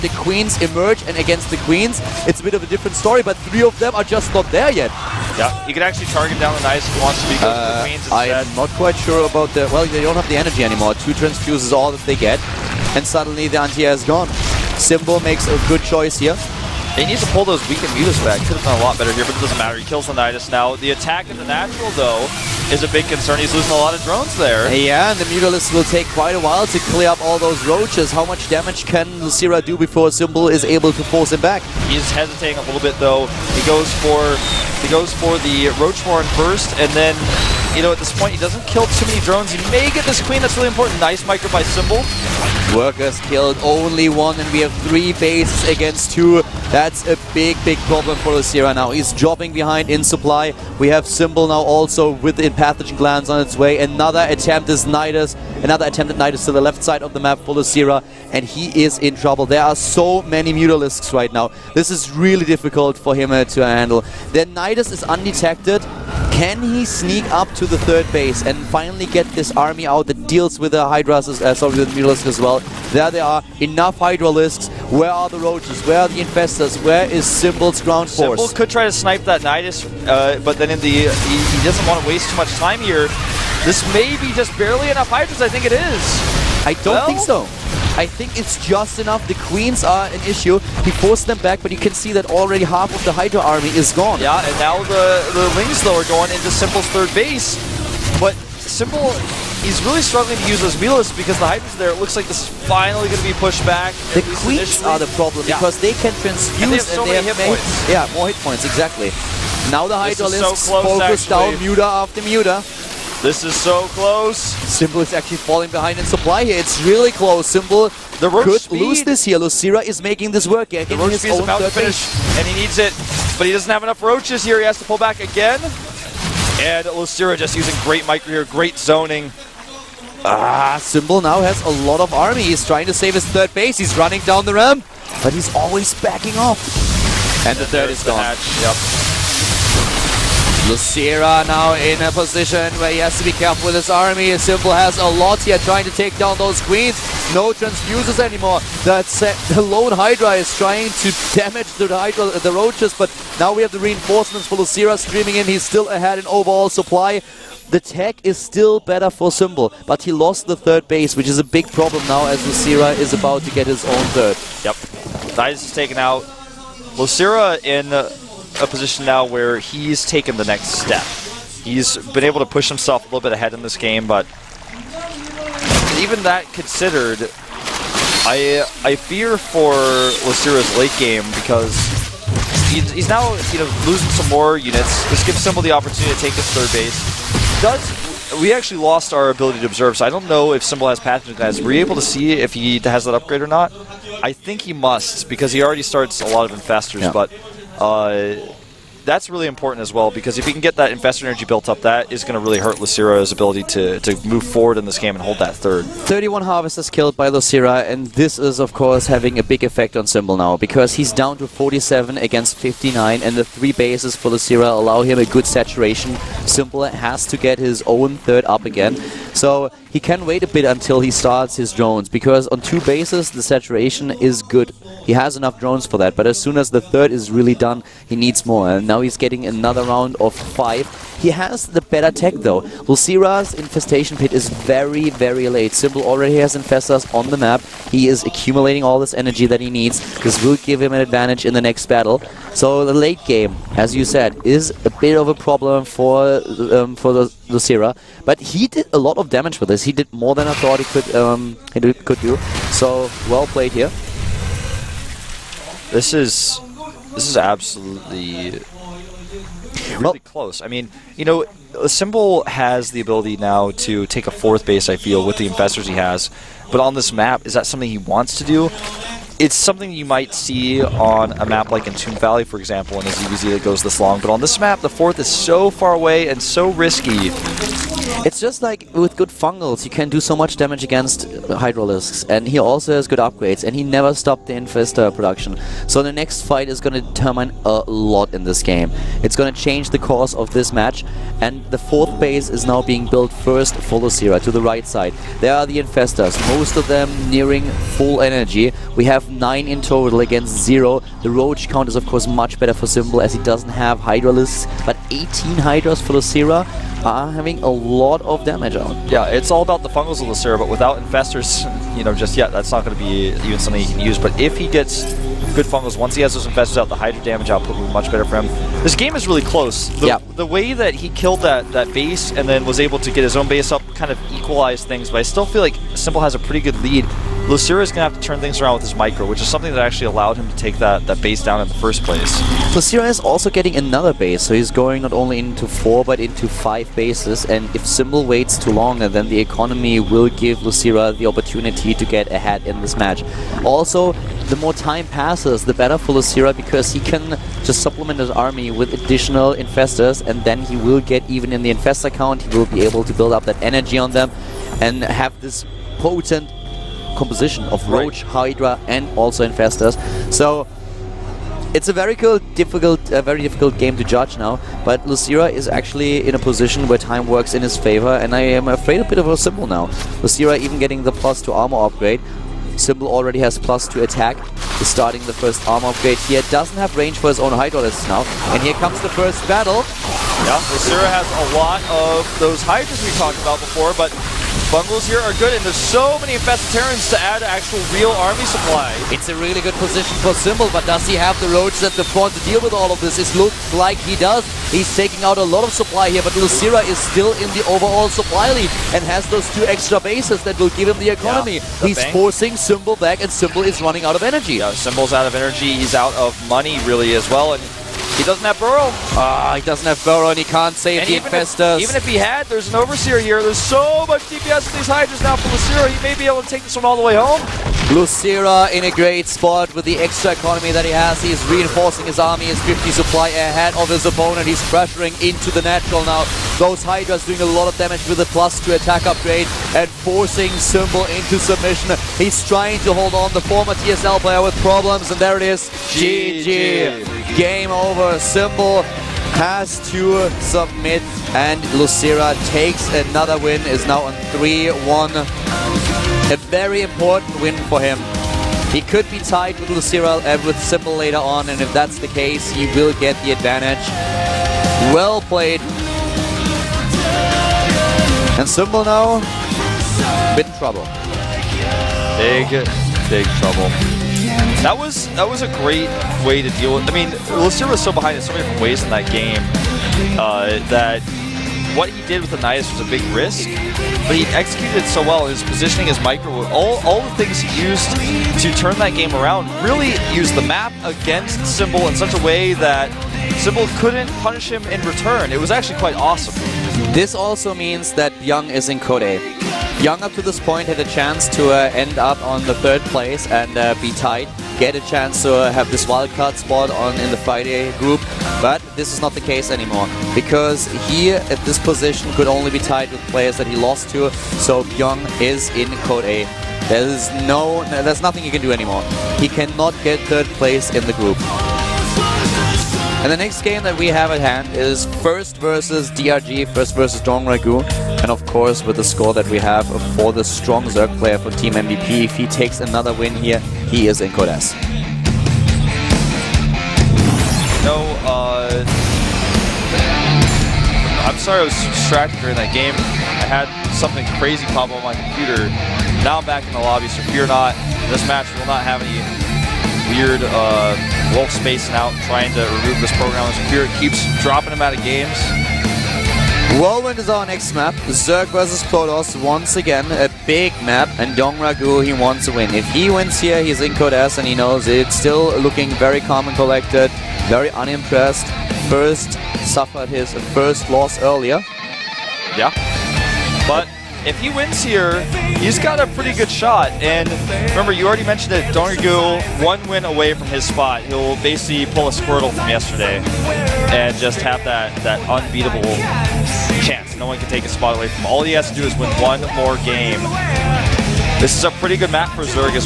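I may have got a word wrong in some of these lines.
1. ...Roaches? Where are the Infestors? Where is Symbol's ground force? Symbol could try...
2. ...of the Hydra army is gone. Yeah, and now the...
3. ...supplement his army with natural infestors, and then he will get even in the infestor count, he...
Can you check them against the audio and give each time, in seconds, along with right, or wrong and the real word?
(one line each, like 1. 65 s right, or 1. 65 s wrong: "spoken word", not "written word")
1. 75 s right
2. 92 s right
3. 347 s wrong: "additional", not "natural".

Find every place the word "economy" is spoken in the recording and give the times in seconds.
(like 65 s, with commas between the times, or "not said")
339 s, 401 s, 420 s.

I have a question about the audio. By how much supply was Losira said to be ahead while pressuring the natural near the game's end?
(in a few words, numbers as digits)
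50 supply.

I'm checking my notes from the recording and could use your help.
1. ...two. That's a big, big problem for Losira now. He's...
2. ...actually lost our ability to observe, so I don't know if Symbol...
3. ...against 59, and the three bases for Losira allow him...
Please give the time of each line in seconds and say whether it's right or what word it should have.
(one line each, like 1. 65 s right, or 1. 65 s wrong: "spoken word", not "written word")
1. 46 s right
2. 188 s right
3. 212 s right.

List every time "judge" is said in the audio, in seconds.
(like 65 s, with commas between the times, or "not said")
364 s.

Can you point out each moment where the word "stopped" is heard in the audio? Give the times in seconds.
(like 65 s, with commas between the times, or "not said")
284 s.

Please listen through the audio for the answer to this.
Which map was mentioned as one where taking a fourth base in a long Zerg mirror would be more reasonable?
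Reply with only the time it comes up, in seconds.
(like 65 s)
271 s.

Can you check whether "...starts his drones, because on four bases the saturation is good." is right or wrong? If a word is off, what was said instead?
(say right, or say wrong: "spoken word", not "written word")
wrong: "two", not "four".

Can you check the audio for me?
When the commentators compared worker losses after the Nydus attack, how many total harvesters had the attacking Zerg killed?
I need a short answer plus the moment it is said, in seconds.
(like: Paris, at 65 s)
31, at 205 s.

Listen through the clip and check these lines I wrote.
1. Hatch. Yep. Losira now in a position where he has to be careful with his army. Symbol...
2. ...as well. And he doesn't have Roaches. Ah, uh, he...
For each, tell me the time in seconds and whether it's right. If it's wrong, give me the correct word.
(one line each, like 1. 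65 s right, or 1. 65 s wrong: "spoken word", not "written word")
1. 138 s right
2. 407 s wrong: "Burrow", not "Roaches".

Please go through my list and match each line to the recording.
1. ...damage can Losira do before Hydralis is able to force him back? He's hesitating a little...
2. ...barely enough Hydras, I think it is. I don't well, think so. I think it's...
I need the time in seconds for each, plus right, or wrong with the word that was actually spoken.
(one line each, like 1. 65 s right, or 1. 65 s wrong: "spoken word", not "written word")
1. 28 s wrong: "Symbol", not "Hydralis"
2. 84 s right.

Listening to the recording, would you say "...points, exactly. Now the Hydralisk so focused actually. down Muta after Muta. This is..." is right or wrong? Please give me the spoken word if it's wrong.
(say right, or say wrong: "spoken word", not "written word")
right.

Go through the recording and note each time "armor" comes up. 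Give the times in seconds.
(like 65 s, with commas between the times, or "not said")
371 s, 375 s.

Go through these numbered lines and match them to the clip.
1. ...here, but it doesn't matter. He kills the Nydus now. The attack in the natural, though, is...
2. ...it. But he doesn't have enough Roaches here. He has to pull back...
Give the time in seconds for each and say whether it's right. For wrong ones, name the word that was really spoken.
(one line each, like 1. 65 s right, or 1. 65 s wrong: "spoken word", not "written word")
1. 19 s right
2. 122 s right.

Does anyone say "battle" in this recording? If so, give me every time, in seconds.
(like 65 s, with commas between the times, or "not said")
241 s, 379 s.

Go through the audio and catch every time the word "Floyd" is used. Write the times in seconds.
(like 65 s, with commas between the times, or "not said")
not said.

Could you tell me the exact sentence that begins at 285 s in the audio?
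So the next fight is going to determine a lot in this game.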